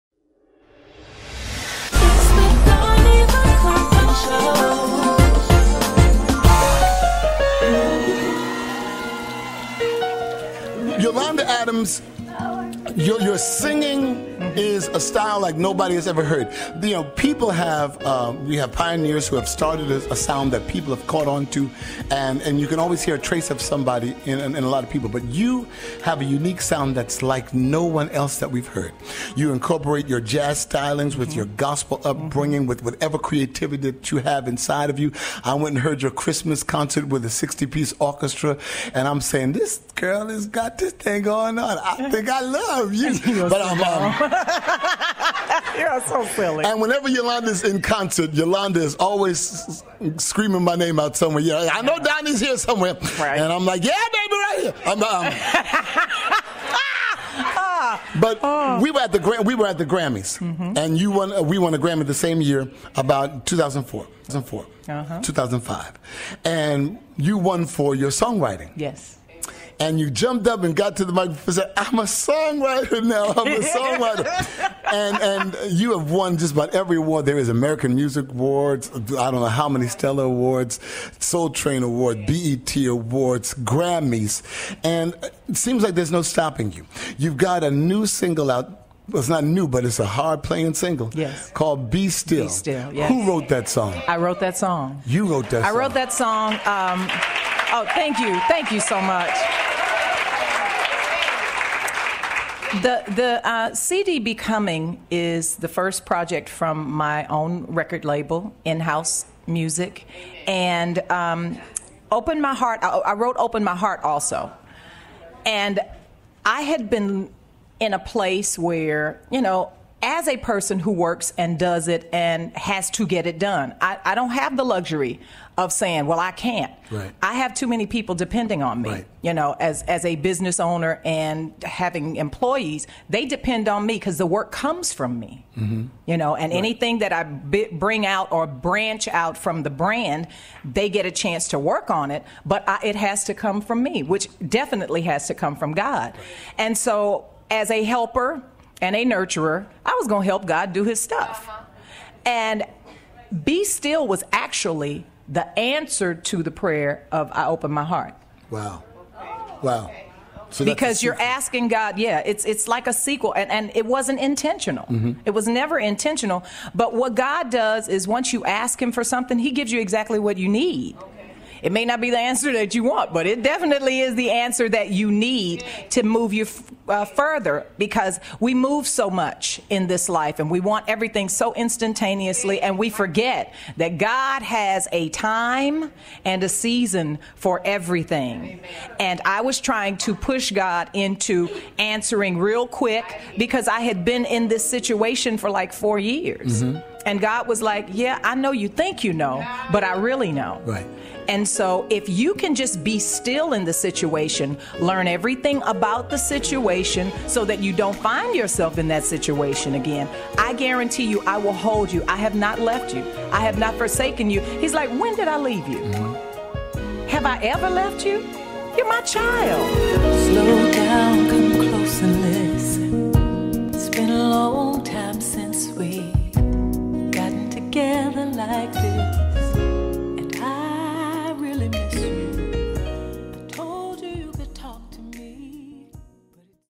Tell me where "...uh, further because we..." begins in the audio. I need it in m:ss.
2:56.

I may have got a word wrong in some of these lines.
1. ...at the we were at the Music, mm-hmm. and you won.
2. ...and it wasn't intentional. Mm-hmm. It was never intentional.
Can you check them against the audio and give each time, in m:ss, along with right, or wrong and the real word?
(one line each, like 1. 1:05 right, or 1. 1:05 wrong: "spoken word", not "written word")
1. 0:58 wrong: "Grammys", not "Music"
2. 2:43 right.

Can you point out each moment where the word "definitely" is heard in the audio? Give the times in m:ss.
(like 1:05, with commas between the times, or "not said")
2:24, 2:53.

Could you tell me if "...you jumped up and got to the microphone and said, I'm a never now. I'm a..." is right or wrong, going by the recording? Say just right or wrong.
wrong.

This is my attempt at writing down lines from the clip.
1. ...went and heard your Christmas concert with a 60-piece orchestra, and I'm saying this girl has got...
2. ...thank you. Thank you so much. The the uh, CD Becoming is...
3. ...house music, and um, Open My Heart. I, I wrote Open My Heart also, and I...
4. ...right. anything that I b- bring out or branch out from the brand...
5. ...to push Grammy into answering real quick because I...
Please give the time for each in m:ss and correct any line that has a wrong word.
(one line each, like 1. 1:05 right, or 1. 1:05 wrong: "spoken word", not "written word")
1. 0:35 right
2. 1:37 right
3. 1:48 right
4. 2:16 right
5. 3:09 wrong: "God", not "Grammy".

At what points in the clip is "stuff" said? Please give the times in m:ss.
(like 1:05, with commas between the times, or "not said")
2:30.